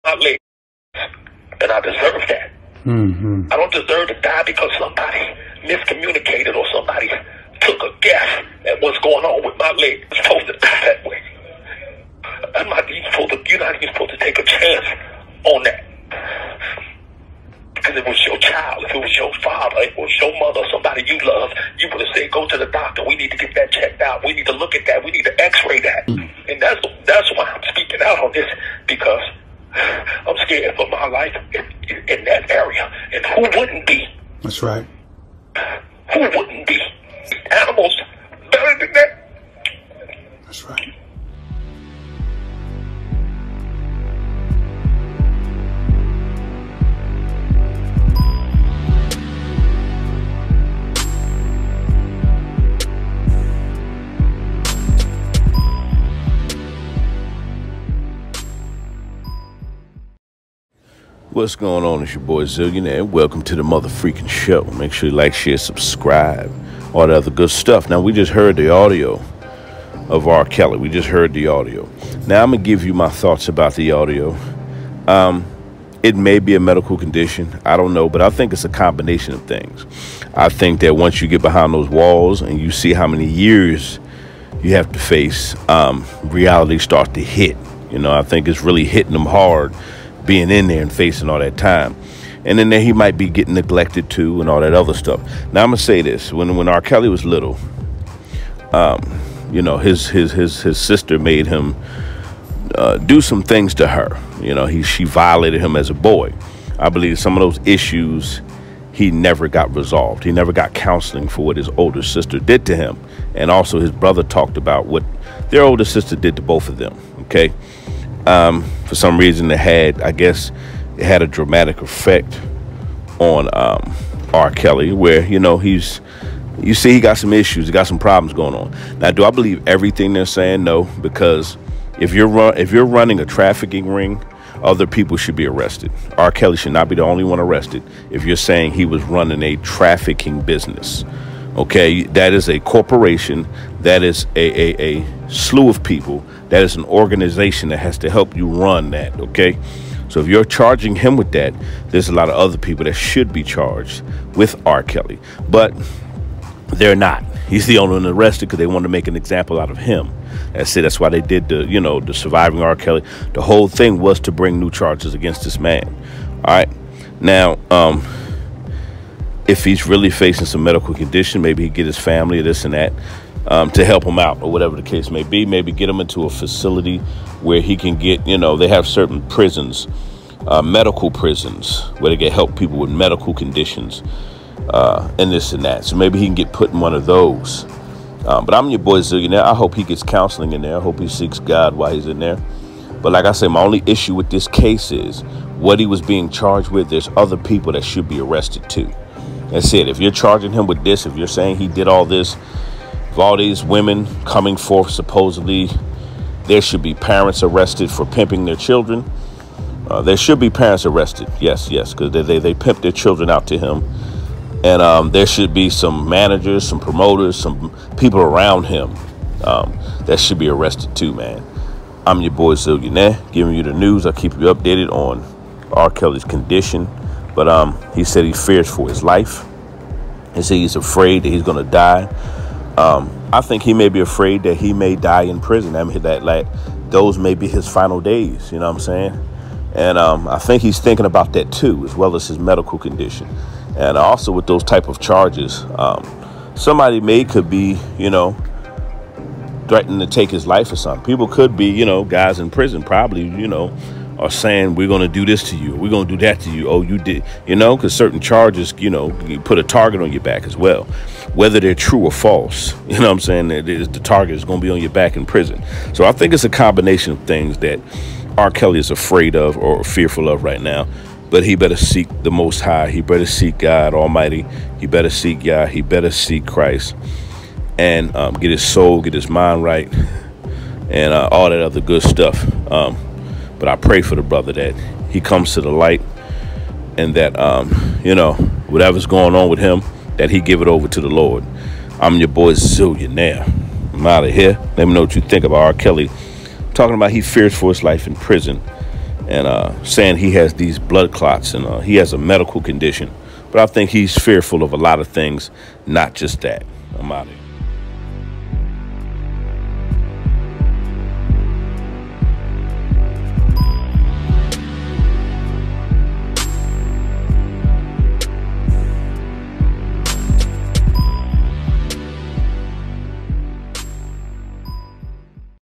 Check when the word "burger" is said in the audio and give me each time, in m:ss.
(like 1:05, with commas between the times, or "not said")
not said.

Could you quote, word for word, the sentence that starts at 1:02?
It's your boy Zillionaire, and welcome to the motherfreaking show.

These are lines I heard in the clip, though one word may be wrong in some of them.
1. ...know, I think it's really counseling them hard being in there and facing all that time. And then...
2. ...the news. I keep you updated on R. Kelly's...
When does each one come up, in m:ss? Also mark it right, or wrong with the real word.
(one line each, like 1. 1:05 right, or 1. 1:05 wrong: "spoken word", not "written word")
1. 1:27 wrong: "hitting", not "counseling"
2. 3:43 right.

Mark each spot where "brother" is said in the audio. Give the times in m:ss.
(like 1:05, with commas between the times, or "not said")
1:53, 4:44.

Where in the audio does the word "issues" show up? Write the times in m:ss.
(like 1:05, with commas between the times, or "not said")
1:47, 2:07, 3:13.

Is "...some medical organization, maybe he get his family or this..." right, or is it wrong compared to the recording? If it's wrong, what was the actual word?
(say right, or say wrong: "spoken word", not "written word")
wrong: "condition", not "organization".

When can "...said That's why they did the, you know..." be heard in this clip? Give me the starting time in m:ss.
2:40.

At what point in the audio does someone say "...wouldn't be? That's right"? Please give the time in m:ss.
0:33.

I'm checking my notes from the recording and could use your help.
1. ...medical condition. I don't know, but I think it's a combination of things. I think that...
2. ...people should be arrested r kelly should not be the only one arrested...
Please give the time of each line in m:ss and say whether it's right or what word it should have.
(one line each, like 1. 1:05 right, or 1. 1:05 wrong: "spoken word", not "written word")
1. 1:16 right
2. 2:14 right.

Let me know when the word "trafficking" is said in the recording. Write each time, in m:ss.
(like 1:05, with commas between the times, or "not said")
2:13, 2:19.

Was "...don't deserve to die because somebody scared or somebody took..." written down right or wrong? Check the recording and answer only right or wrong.
wrong.